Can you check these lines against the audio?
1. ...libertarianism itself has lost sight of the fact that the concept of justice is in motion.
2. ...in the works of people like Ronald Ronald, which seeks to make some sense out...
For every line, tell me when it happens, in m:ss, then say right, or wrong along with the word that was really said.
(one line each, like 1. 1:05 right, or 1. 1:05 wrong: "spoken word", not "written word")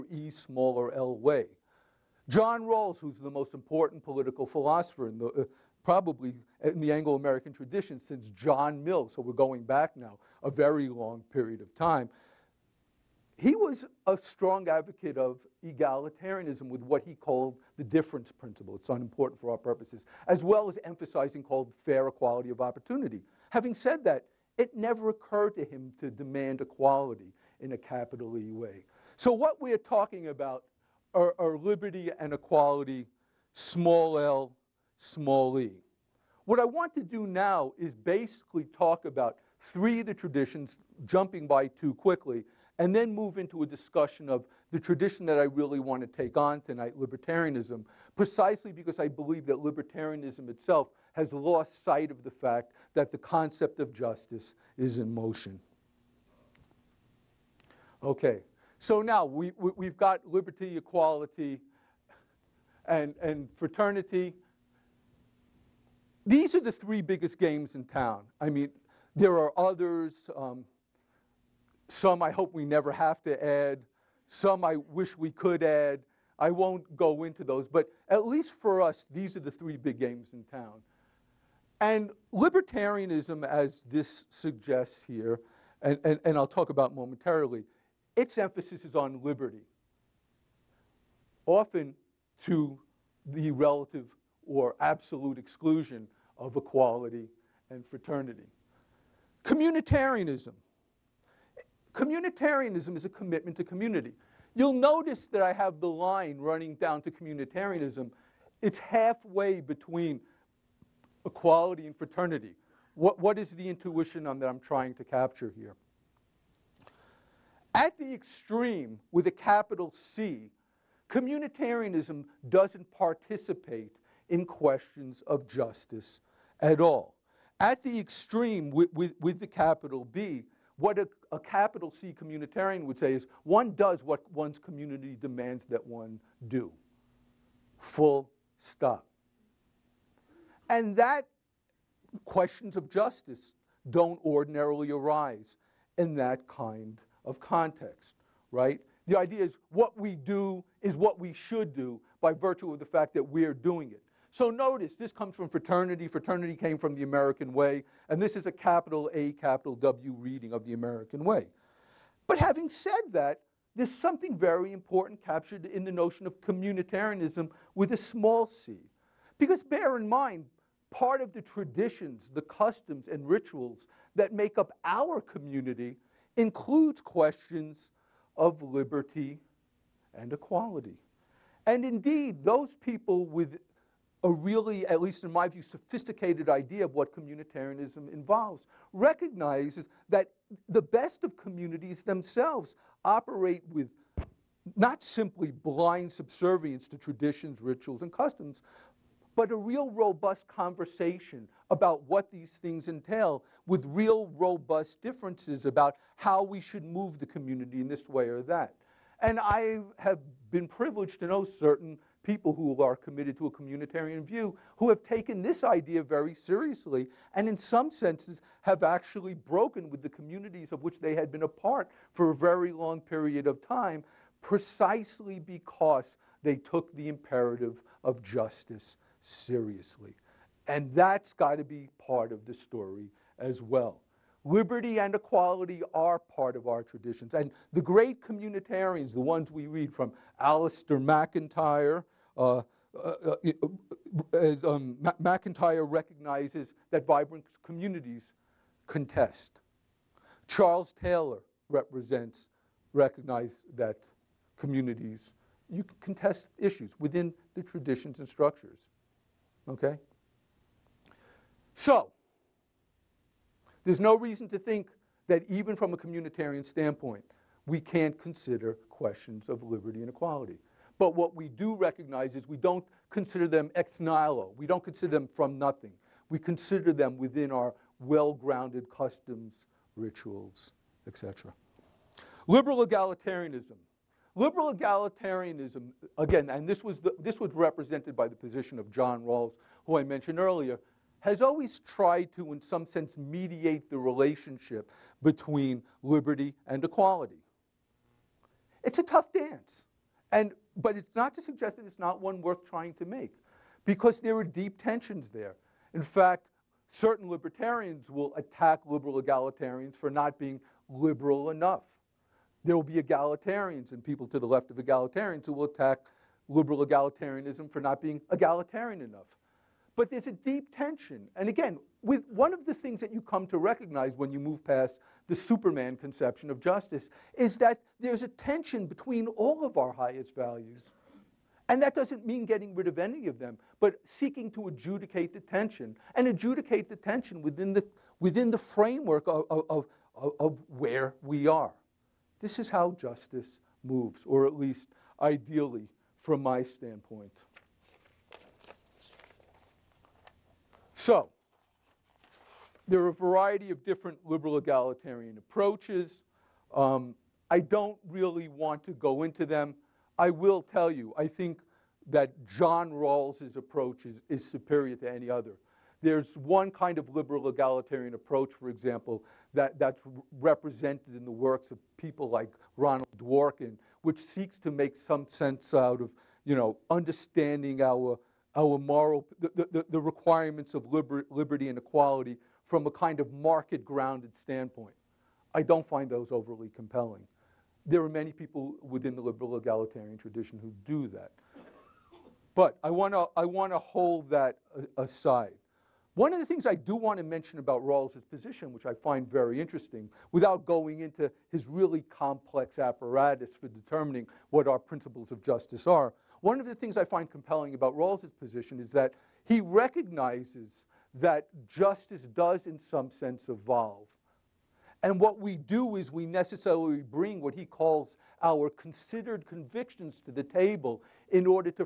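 1. 0:49 right
2. 6:11 wrong: "Dworkin", not "Ronald".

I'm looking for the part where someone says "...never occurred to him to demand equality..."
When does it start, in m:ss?
0:24.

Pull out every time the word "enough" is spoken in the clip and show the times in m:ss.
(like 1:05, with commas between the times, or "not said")
5:11, 5:19.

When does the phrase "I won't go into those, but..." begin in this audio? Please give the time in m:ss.
1:16.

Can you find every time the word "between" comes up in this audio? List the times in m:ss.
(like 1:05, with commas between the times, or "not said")
1:49, 4:55, 5:28.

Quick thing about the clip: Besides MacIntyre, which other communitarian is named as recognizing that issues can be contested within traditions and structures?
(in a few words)
Charles Taylor.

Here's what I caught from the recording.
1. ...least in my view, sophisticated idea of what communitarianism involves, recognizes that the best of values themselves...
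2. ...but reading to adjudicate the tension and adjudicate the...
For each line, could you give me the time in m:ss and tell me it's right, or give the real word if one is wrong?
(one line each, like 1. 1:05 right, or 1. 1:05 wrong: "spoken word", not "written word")
1. 3:05 wrong: "communities", not "values"
2. 5:33 wrong: "seeking", not "reading".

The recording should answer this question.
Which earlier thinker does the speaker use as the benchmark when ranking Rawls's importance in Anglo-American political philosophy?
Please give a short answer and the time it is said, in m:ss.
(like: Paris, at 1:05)
John Mill, at 0:08.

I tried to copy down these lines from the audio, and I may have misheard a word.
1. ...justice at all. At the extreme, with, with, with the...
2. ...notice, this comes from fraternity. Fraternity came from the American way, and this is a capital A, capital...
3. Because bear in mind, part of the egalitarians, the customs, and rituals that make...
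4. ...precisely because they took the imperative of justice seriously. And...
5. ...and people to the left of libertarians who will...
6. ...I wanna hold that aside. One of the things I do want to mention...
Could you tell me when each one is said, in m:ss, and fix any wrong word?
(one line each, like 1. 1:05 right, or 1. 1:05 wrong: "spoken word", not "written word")
1. 2:05 right
2. 2:34 right
3. 2:49 wrong: "traditions", not "egalitarians"
4. 3:44 right
5. 5:13 wrong: "egalitarians", not "libertarians"
6. 6:33 right.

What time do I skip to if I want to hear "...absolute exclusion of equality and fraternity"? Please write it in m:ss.
1:34.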